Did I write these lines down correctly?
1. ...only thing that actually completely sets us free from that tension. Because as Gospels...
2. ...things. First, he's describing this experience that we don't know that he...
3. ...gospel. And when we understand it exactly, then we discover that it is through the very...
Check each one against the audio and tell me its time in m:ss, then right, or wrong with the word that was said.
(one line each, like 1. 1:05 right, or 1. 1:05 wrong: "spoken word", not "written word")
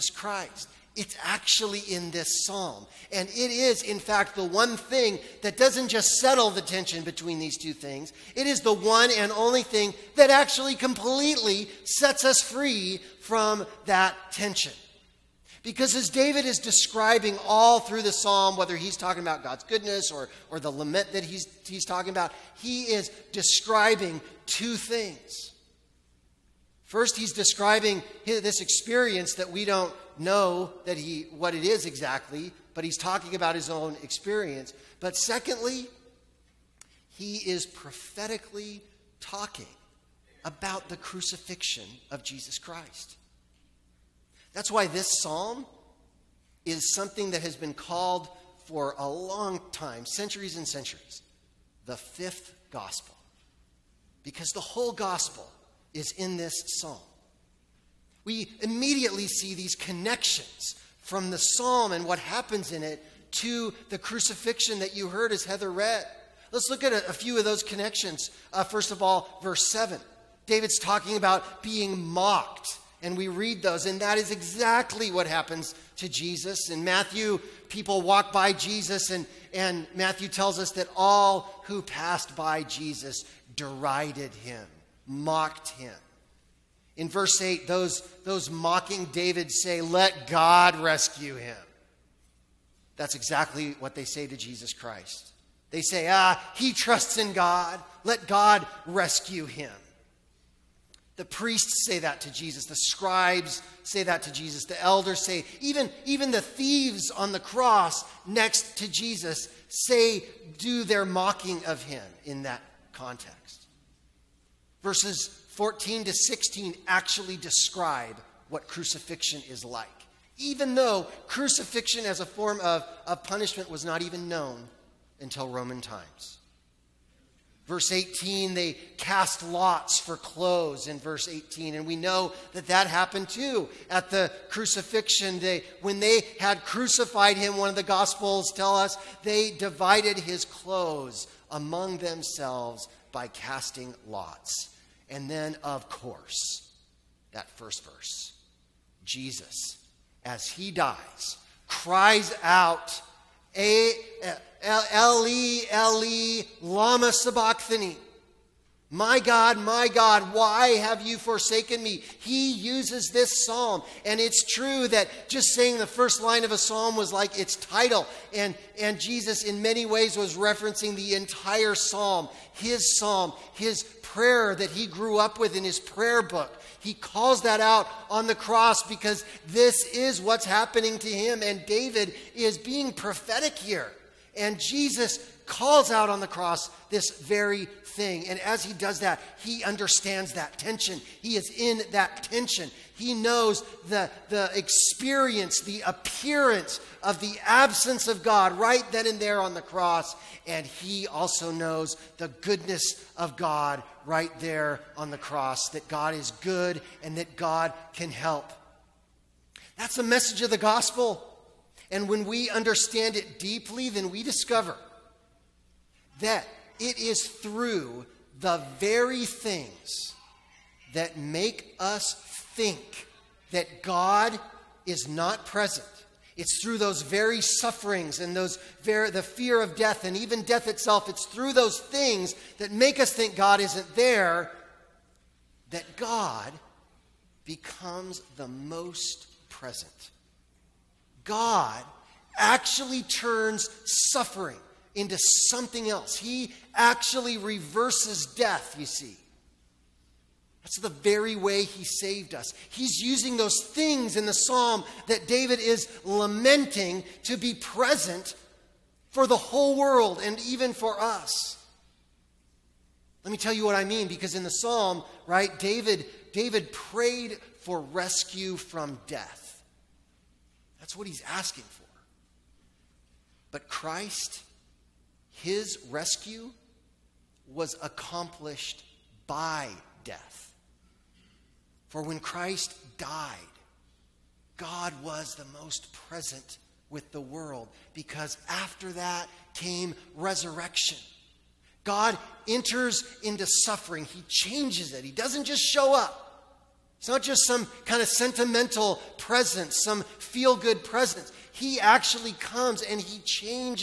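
1. 0:09 wrong: "David", not "Gospels"
2. 0:24 right
3. 3:30 wrong: "deeply", not "exactly".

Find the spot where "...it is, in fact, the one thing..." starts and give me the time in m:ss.
0:03.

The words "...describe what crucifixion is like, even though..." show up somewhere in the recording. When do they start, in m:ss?
1:57.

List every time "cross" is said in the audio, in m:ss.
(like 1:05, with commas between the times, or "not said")
1:47, 2:58, 3:06, 3:19, 3:25.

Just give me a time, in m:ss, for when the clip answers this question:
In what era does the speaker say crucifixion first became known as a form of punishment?
2:05.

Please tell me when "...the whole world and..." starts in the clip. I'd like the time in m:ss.
4:19.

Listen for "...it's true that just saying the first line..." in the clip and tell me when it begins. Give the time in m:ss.
2:44.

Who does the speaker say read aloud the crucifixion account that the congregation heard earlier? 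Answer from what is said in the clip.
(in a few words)
Heather.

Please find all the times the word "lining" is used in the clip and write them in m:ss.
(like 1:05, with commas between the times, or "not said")
not said.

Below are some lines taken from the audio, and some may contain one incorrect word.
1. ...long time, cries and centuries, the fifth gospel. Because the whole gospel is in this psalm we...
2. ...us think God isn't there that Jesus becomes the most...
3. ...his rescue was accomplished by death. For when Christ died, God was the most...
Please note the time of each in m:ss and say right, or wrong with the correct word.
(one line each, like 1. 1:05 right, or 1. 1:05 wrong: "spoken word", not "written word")
1. 0:49 wrong: "centuries", not "cries"
2. 3:52 wrong: "God", not "Jesus"
3. 4:35 right.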